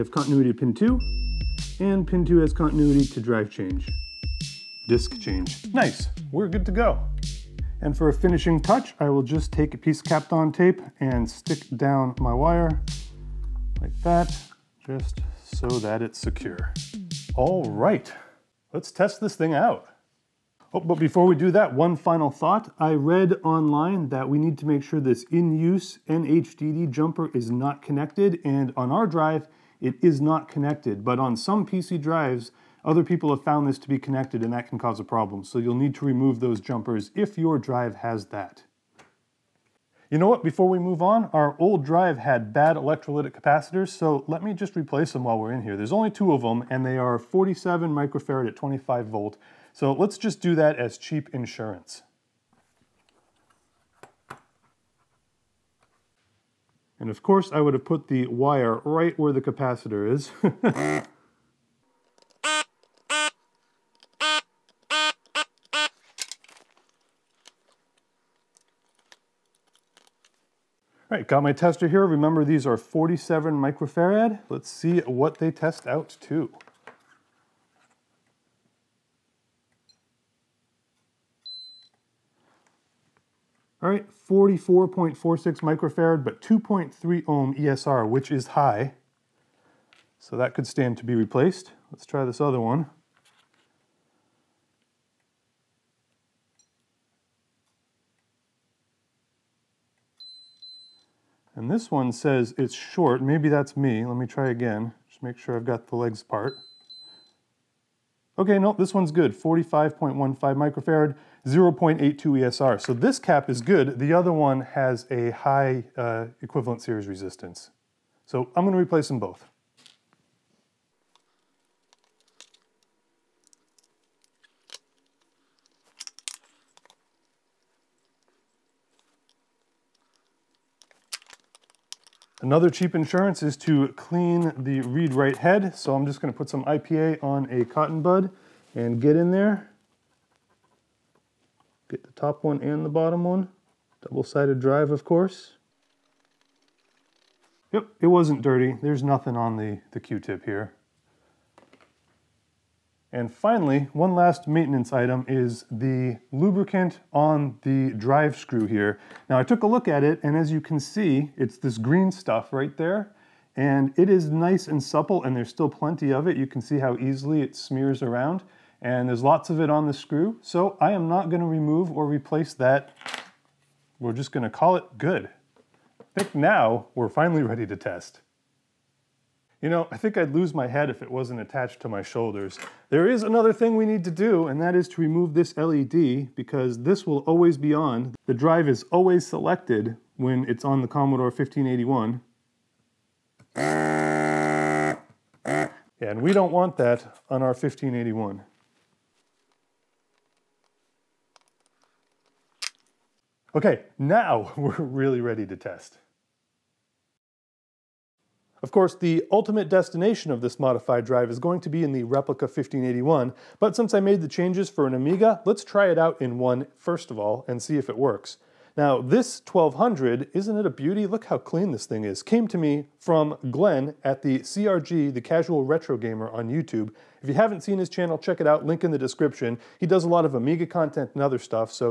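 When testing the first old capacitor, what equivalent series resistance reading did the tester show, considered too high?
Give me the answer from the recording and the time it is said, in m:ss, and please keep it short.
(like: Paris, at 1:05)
2.3 ohm, at 1:26.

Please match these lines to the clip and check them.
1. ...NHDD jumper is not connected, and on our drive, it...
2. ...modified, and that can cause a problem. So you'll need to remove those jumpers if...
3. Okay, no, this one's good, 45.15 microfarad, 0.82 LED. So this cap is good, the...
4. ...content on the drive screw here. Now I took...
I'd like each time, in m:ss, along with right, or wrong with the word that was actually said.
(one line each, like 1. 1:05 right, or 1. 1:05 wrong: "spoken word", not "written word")
1. 0:26 right
2. 0:33 wrong: "connected", not "modified"
3. 1:48 wrong: "ESR", not "LED"
4. 2:36 wrong: "lubricant", not "content".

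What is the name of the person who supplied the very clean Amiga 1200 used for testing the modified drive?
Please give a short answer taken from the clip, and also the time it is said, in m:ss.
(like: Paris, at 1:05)
Glenn, at 3:43.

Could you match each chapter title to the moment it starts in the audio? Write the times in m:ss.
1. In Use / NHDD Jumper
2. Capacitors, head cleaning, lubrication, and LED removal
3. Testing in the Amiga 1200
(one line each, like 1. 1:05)
1. 0:20
2. 0:39
3. 3:27.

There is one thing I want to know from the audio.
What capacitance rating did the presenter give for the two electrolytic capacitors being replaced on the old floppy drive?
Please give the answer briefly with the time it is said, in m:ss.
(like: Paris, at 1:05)
47 microfarad, at 0:47.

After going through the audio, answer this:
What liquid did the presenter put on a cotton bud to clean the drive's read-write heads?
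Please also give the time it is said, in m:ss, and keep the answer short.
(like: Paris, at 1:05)
IPA, at 2:16.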